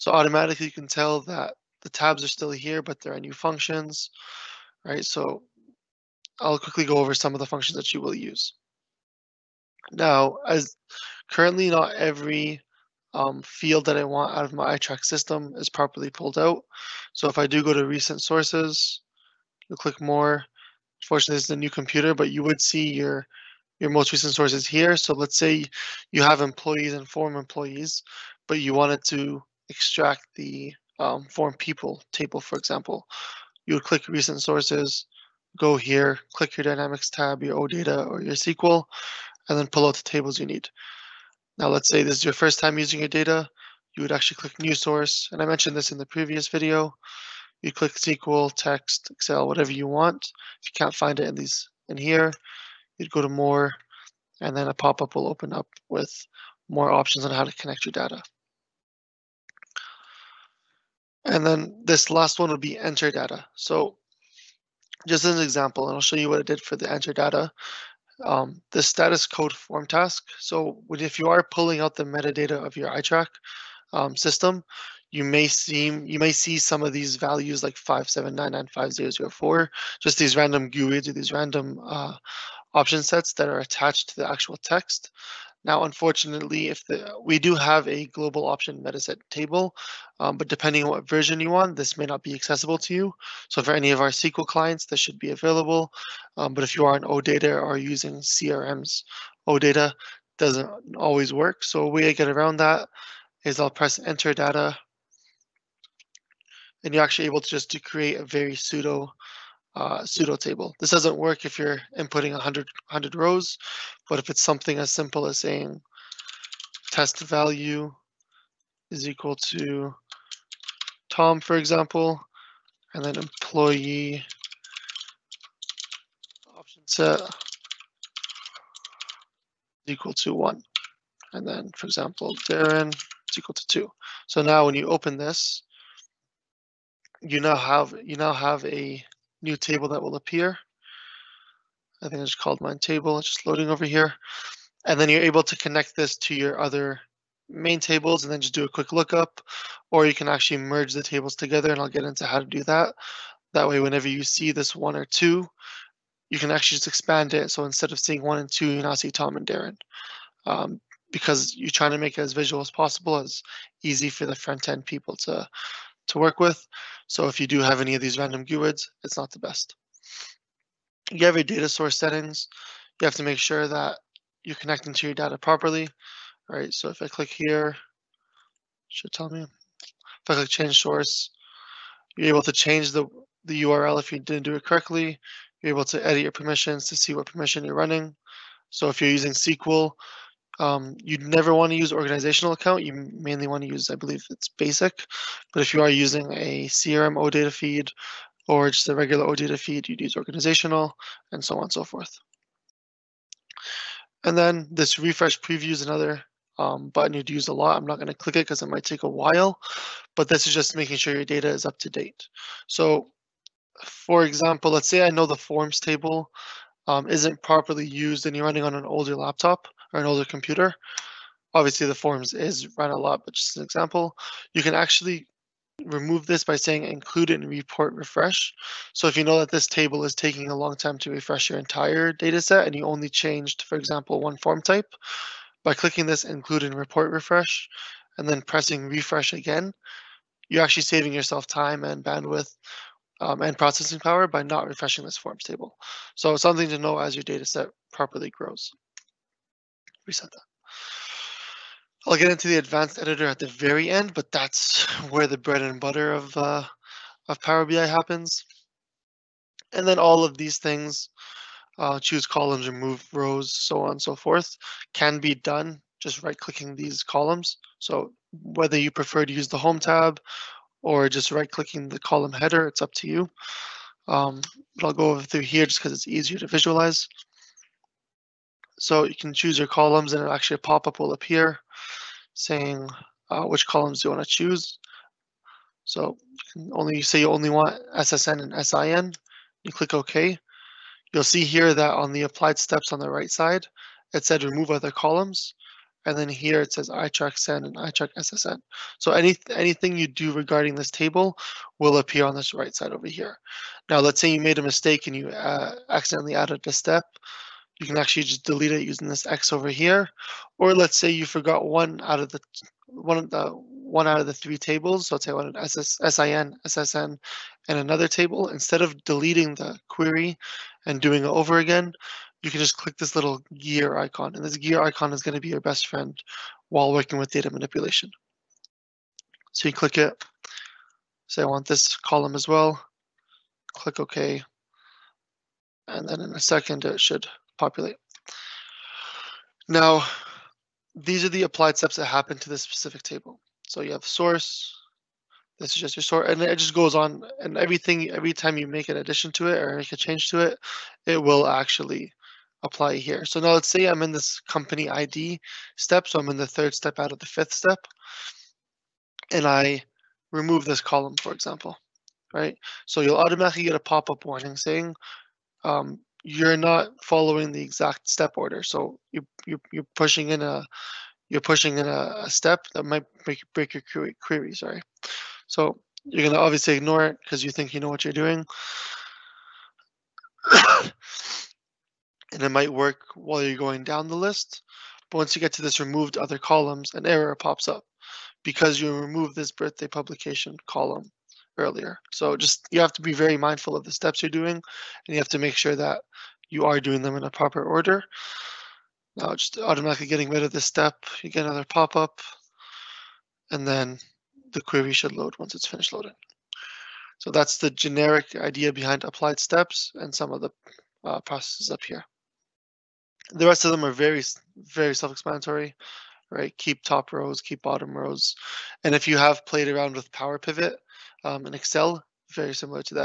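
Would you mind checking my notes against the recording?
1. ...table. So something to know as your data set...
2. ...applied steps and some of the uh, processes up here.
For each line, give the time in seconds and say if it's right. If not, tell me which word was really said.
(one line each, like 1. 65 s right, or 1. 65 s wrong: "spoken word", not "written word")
1. 245 s right
2. 409 s right.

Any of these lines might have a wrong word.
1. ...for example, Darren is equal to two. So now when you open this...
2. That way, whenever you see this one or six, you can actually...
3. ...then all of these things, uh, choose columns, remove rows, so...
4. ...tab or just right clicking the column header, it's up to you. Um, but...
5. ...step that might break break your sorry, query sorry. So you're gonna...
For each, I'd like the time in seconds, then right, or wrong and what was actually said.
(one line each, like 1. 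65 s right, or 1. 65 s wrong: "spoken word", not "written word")
1. 131 s right
2. 153 s wrong: "two", not "six"
3. 259 s right
4. 269 s right
5. 372 s wrong: "query", not "sorry".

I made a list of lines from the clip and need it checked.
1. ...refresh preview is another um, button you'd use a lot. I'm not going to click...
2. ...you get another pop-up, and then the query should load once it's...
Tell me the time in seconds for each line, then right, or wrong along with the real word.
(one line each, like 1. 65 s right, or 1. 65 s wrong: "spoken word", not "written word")
1. 204 s right
2. 401 s right.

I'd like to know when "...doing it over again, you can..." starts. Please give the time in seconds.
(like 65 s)
320 s.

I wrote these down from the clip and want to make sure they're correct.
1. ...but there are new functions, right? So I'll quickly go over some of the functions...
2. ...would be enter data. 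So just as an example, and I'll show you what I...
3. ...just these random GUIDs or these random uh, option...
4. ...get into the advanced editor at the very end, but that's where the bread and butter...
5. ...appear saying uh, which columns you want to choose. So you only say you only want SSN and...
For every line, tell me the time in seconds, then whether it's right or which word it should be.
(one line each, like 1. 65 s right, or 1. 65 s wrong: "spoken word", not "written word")
1. 2 s right
2. 62 s right
3. 79 s right
4. 252 s right
5. 281 s right.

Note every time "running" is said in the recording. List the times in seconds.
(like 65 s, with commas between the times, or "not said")
187 s, 218 s.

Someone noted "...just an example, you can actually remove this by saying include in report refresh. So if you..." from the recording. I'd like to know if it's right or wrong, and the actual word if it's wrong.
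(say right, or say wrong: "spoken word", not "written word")
right.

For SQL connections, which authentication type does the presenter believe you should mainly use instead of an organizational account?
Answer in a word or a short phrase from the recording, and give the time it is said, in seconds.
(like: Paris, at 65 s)
basic, at 193 s.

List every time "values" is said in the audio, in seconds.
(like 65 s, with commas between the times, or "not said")
77 s, 117 s.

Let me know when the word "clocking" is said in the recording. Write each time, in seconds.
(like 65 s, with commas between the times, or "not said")
not said.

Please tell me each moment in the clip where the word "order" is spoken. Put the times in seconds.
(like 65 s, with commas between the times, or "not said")
368 s, 397 s.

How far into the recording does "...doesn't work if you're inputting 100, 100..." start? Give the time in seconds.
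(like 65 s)
110 s.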